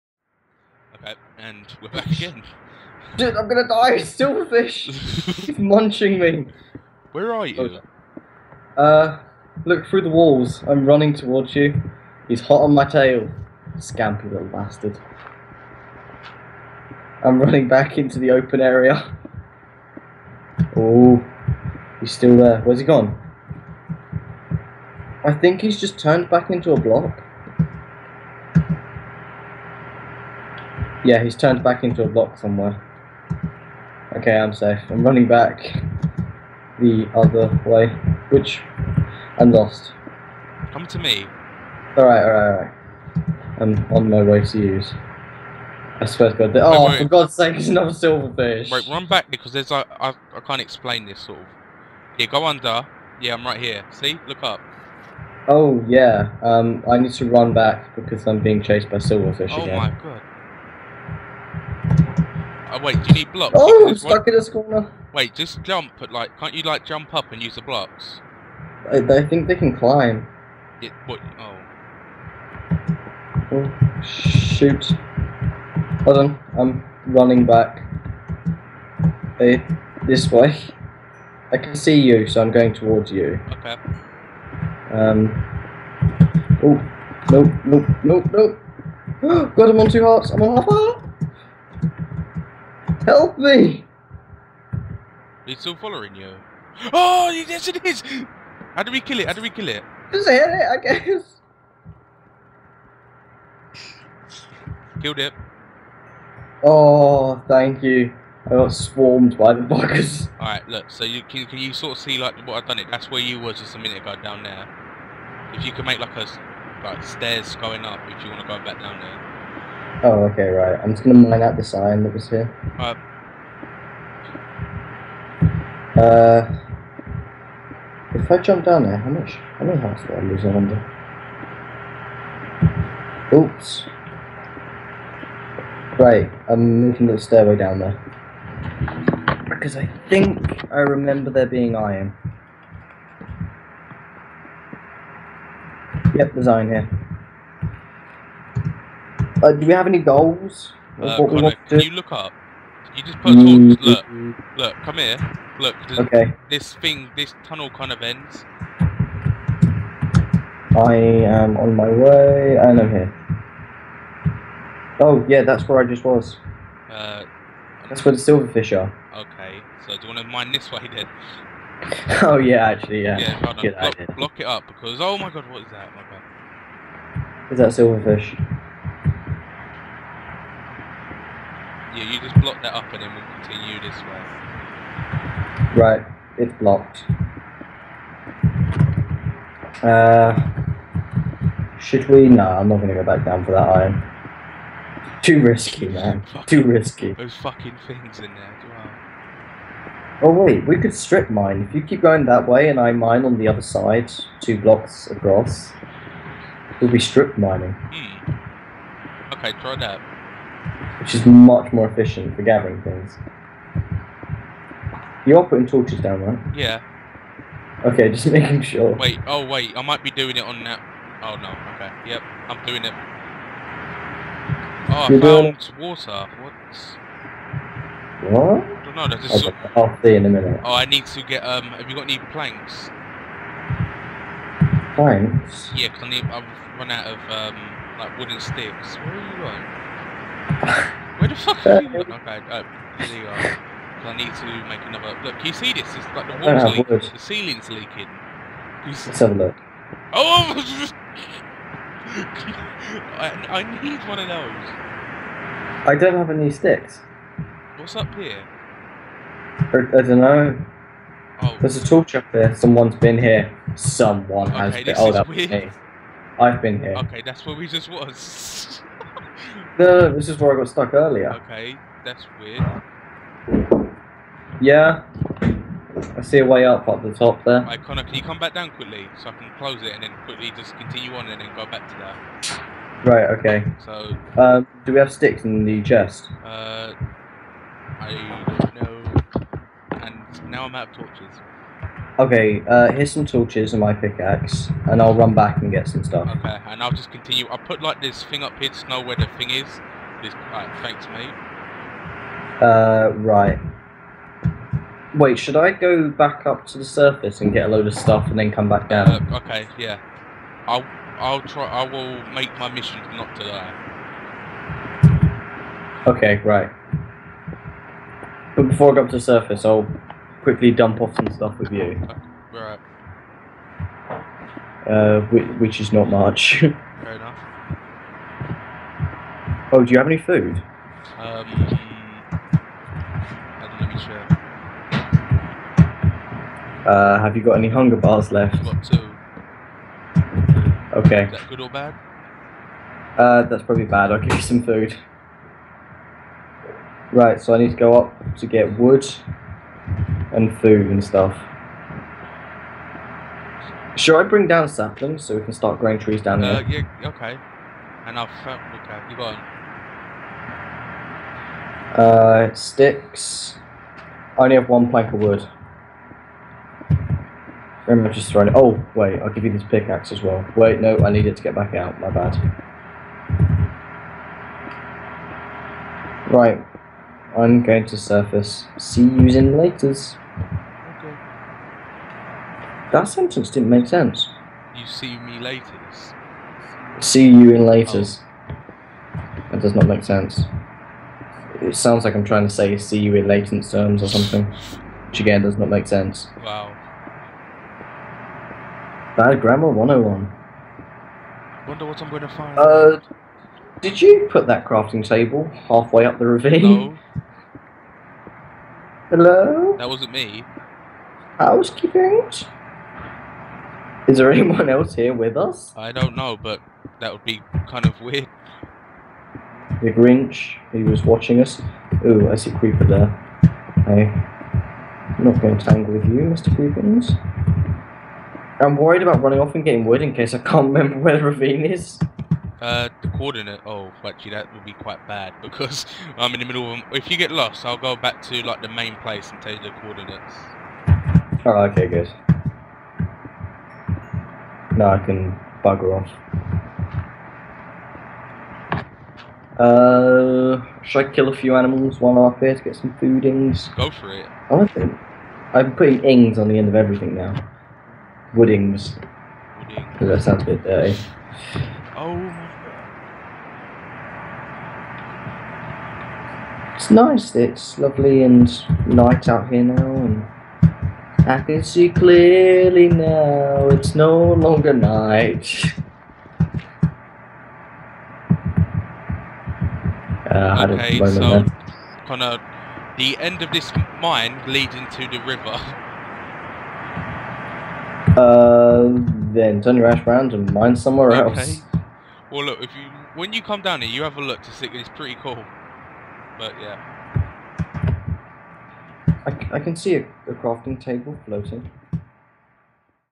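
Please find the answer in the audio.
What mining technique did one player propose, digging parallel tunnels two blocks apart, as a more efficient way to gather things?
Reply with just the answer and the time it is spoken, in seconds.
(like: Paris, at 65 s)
strip mining, at 200 s.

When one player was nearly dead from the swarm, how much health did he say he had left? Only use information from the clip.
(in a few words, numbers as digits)
half heart.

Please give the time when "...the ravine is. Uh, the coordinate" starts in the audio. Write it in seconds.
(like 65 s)
431 s.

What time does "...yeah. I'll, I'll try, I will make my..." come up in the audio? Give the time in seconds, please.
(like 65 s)
309 s.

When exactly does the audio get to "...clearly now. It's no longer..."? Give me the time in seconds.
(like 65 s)
471 s.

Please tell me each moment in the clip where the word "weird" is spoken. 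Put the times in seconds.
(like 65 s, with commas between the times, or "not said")
272 s, 418 s.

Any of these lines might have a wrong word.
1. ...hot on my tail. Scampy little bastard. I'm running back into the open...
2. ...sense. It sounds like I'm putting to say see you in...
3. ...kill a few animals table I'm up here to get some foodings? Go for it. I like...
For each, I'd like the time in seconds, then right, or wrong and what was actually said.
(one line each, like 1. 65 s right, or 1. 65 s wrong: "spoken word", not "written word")
1. 12 s right
2. 390 s wrong: "trying", not "putting"
3. 451 s wrong: "while", not "table".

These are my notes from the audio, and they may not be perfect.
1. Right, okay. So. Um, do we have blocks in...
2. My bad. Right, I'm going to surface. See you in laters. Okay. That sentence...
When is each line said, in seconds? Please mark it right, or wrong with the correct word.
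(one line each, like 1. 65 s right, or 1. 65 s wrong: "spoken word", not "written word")
1. 283 s wrong: "sticks", not "blocks"
2. 371 s right.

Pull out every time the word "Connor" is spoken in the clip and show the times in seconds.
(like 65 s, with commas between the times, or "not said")
151 s, 277 s.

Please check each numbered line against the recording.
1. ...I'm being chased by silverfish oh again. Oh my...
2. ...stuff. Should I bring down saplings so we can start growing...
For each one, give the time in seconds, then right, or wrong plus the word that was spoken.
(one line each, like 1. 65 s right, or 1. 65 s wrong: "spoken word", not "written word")
1. 58 s right
2. 351 s right.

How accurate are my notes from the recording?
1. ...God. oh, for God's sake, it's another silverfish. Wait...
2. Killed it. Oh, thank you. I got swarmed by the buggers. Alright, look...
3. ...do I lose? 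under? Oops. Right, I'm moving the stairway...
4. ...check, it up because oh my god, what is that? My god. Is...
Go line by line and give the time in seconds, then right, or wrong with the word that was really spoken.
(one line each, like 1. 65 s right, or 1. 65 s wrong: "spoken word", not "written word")
1. 46 s right
2. 105 s right
3. 130 s right
4. 174 s wrong: "block", not "check".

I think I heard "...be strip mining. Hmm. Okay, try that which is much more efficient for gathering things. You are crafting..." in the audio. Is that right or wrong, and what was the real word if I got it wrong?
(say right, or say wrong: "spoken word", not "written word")
wrong: "putting", not "crafting".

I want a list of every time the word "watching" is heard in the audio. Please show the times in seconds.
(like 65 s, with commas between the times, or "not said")
421 s.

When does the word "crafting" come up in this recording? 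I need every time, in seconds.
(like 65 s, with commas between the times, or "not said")
404 s, 500 s.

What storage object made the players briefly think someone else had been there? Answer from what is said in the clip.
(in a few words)
tool chest.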